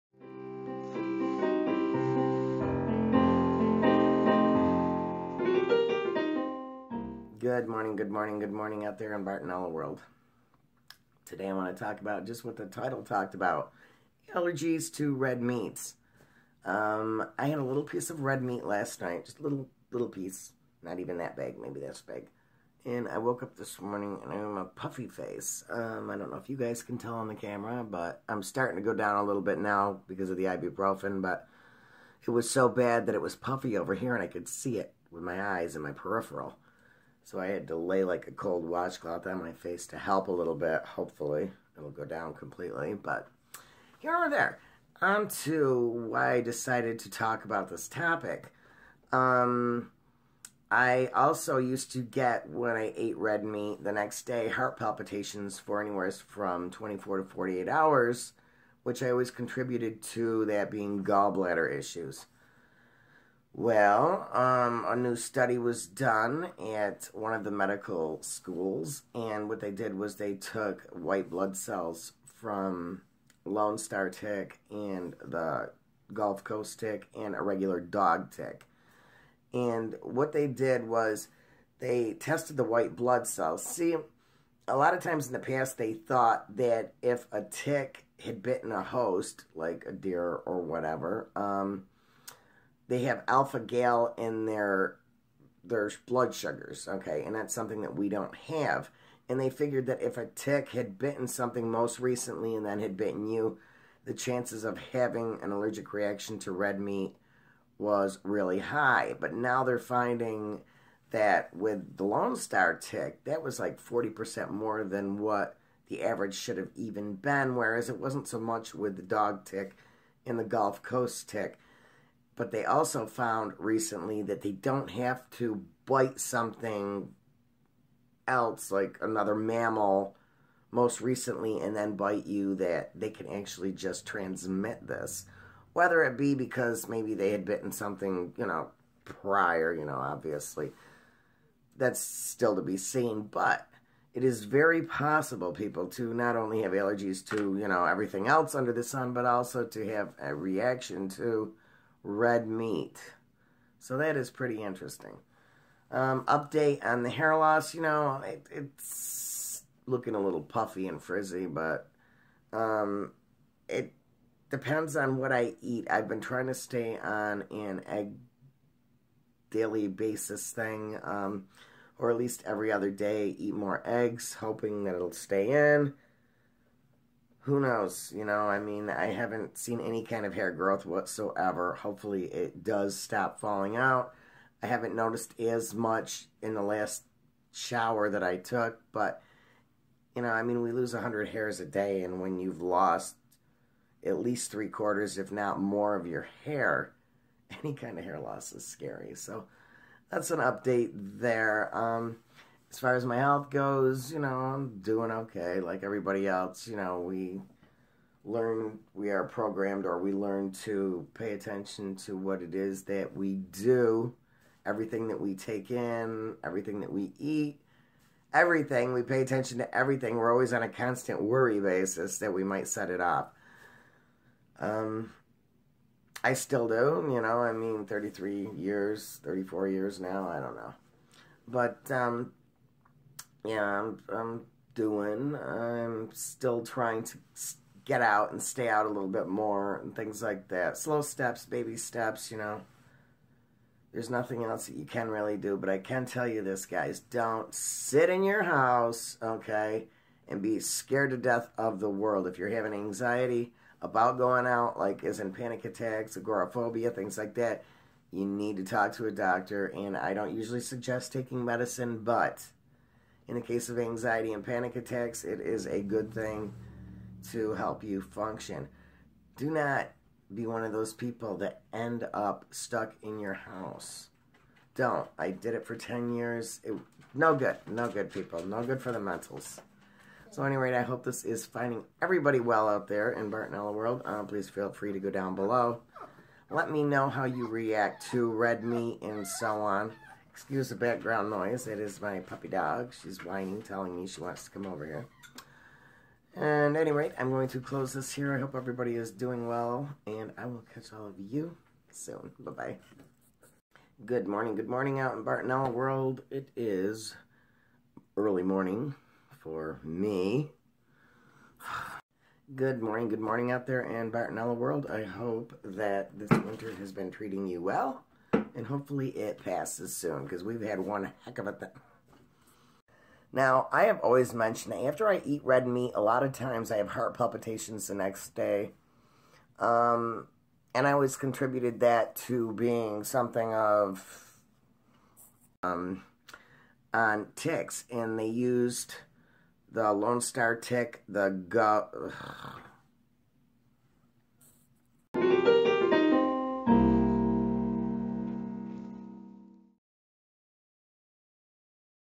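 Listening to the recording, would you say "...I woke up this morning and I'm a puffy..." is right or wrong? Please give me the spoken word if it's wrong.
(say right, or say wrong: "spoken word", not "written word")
right.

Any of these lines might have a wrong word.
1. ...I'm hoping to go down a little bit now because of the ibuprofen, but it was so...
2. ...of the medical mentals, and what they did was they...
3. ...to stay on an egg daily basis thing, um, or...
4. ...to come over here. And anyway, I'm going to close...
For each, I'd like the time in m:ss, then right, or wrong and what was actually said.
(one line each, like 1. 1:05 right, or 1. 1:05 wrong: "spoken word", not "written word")
1. 0:28 wrong: "starting", not "hoping"
2. 1:07 wrong: "schools", not "mentals"
3. 2:46 right
4. 4:54 right.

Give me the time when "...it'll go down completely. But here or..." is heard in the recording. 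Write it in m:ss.
0:41.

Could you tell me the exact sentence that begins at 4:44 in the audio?
Uh, please feel free to go down below.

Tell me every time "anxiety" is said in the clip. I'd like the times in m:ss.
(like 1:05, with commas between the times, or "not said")
4:12, 4:23.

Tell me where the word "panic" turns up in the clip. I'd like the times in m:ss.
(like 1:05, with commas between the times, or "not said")
4:15, 4:24.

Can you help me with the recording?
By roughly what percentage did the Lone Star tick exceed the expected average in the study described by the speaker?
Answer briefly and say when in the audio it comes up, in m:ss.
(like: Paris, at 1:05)
40%, at 1:53.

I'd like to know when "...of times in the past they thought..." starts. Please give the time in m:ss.
1:24.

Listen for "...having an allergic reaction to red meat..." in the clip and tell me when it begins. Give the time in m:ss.
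1:44.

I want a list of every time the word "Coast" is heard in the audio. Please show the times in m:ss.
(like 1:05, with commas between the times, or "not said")
1:16, 2:00.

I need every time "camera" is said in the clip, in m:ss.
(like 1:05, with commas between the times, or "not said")
0:27.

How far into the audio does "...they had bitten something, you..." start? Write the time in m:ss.
2:17.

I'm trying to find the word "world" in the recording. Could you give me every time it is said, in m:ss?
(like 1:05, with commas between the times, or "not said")
0:09, 4:11, 4:43, 5:05, 5:14.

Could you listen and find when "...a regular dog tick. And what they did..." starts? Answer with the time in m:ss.
1:17.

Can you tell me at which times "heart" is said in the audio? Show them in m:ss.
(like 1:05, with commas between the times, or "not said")
0:54, 5:26.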